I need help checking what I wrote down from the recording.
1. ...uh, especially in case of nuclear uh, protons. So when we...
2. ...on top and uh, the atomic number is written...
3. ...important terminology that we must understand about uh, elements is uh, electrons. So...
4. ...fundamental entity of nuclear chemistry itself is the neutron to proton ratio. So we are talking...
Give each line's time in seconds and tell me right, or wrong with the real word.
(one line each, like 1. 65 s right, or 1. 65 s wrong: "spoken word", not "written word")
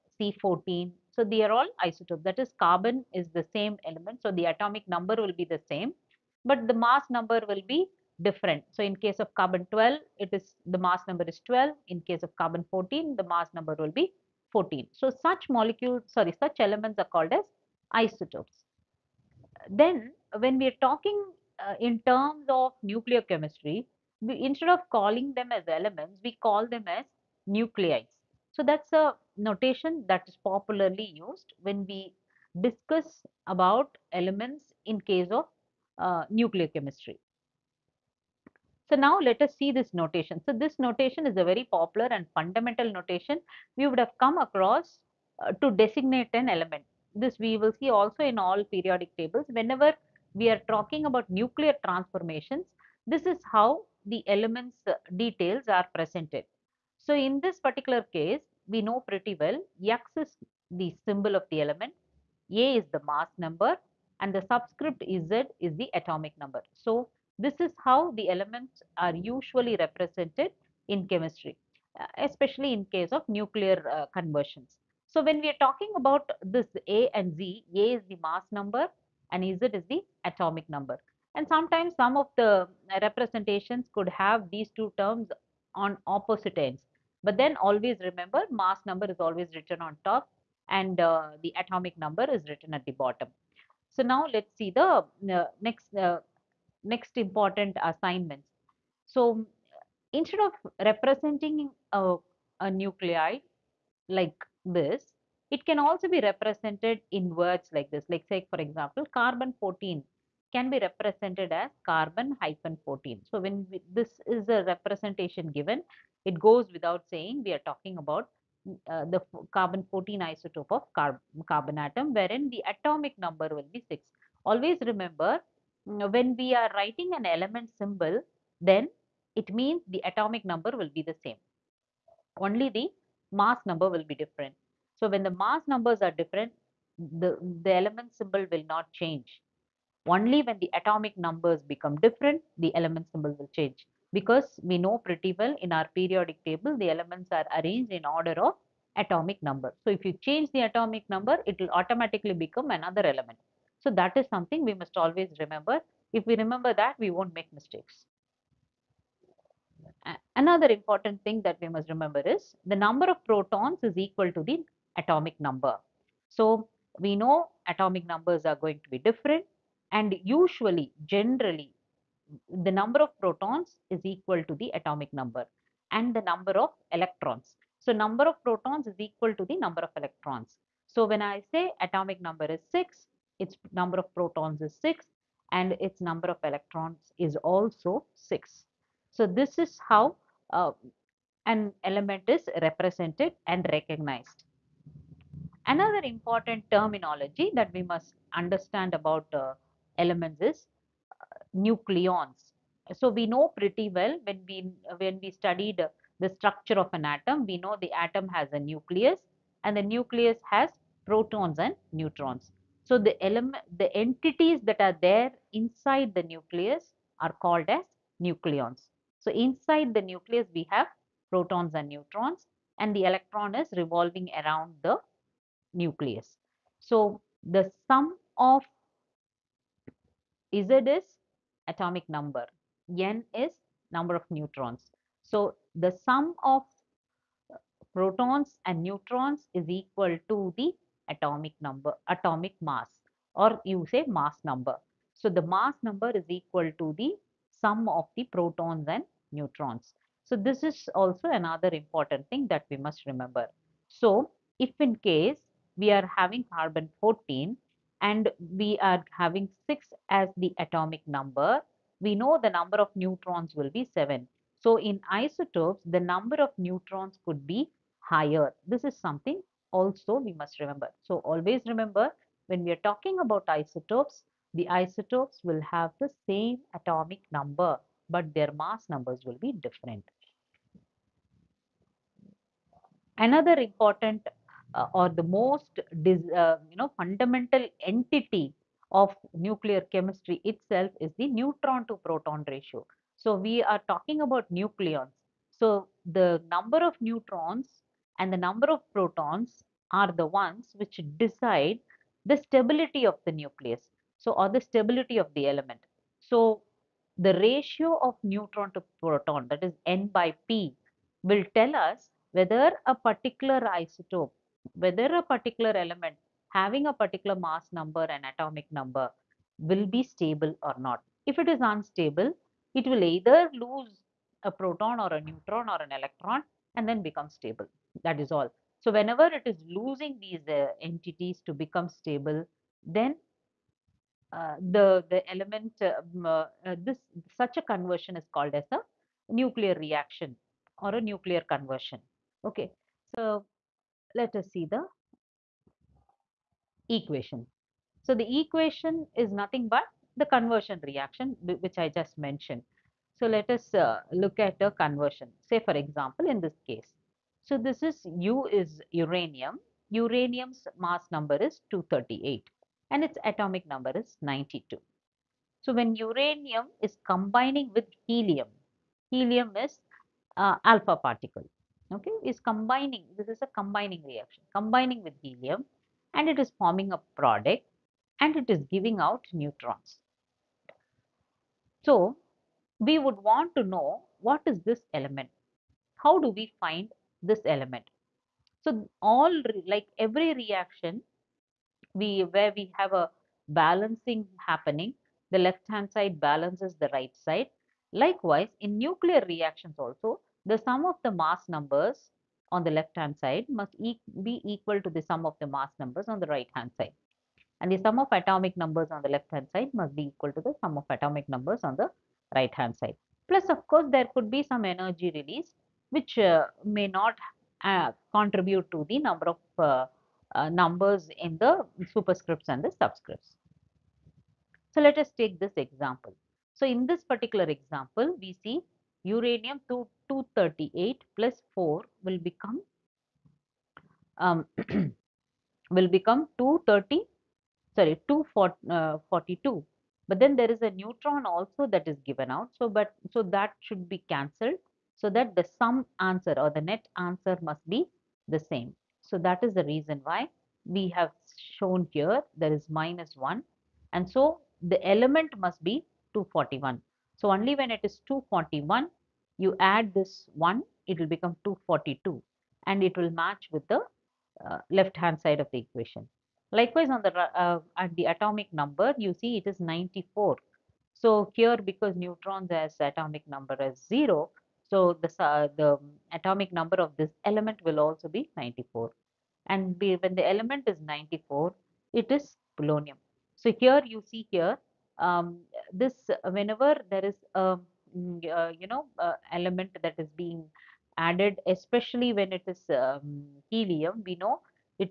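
1. 71 s wrong: "conversions", not "protons"
2. 89 s right
3. 196 s wrong: "nucleons", not "electrons"
4. 286 s right.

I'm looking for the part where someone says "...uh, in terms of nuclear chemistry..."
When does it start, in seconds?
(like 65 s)
21 s.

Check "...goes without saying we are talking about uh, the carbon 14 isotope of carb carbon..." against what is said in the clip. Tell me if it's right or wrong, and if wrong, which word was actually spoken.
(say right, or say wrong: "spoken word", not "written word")
right.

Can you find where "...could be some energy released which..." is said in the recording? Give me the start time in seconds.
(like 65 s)
414 s.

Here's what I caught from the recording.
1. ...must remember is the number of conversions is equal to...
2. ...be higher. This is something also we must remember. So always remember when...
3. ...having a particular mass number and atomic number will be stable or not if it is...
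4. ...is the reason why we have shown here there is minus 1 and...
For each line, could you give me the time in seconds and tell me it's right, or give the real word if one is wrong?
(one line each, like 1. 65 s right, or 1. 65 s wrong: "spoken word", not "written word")
1. 161 s wrong: "protons", not "conversions"
2. 267 s right
3. 316 s right
4. 449 s right.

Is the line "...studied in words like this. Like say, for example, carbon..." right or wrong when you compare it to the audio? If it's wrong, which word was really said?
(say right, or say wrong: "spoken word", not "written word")
wrong: "represented", not "studied".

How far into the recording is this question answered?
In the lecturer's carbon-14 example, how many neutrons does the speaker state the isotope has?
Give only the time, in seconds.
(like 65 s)
263 s.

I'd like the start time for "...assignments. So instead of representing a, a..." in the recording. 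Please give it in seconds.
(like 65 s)
97 s.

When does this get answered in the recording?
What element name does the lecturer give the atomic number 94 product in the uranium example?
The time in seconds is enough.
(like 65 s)
482 s.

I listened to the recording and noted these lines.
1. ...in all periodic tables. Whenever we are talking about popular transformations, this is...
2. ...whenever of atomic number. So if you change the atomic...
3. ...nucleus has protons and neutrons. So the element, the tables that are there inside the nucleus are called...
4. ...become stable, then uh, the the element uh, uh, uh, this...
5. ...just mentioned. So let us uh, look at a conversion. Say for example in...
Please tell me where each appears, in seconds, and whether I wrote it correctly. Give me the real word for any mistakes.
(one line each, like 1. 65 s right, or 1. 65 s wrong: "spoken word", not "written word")
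1. 48 s wrong: "nuclear", not "popular"
2. 148 s wrong: "order", not "whenever"
3. 209 s wrong: "entities", not "tables"
4. 331 s right
5. 351 s right.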